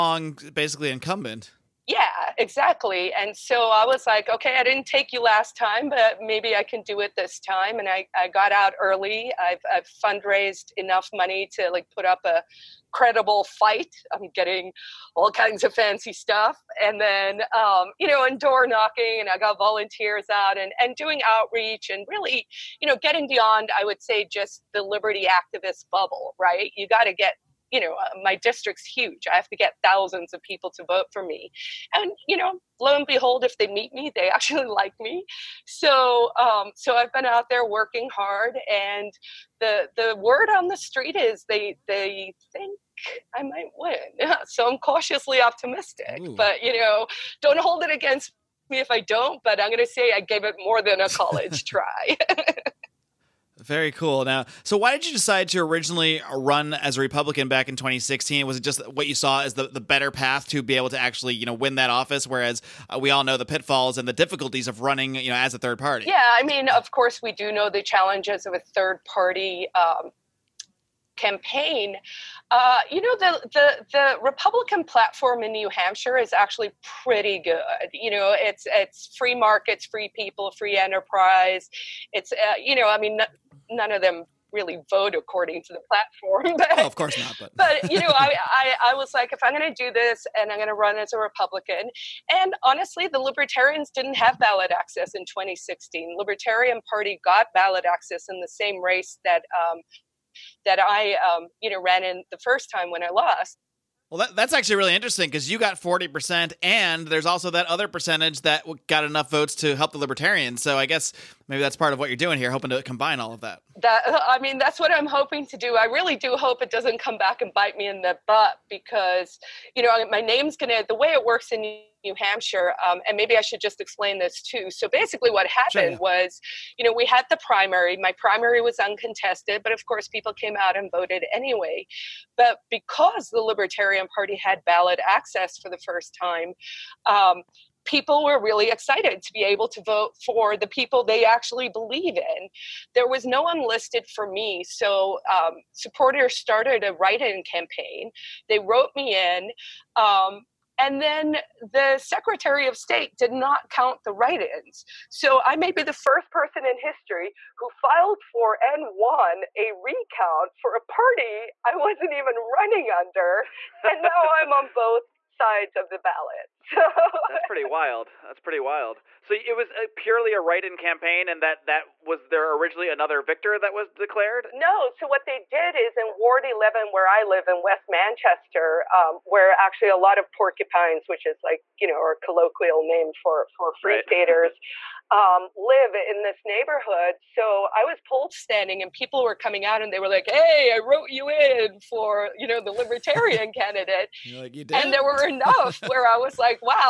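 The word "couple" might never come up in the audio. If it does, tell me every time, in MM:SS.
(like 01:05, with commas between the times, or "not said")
not said.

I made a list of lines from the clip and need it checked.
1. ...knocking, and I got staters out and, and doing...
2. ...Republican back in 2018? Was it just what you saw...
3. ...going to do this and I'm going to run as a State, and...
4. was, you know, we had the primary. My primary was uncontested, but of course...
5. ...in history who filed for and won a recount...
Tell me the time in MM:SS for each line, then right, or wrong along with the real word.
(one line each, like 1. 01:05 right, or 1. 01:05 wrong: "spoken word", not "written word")
1. 00:18 wrong: "volunteers", not "staters"
2. 00:57 wrong: "2016", not "2018"
3. 01:29 wrong: "Republican", not "State"
4. 02:05 right
5. 02:36 right.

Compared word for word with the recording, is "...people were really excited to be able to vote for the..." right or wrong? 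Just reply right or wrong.
right.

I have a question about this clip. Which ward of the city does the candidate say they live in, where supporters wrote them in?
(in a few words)
Ward 11.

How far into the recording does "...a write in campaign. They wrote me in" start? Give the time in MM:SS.
02:26.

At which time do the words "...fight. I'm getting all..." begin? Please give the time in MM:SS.
00:13.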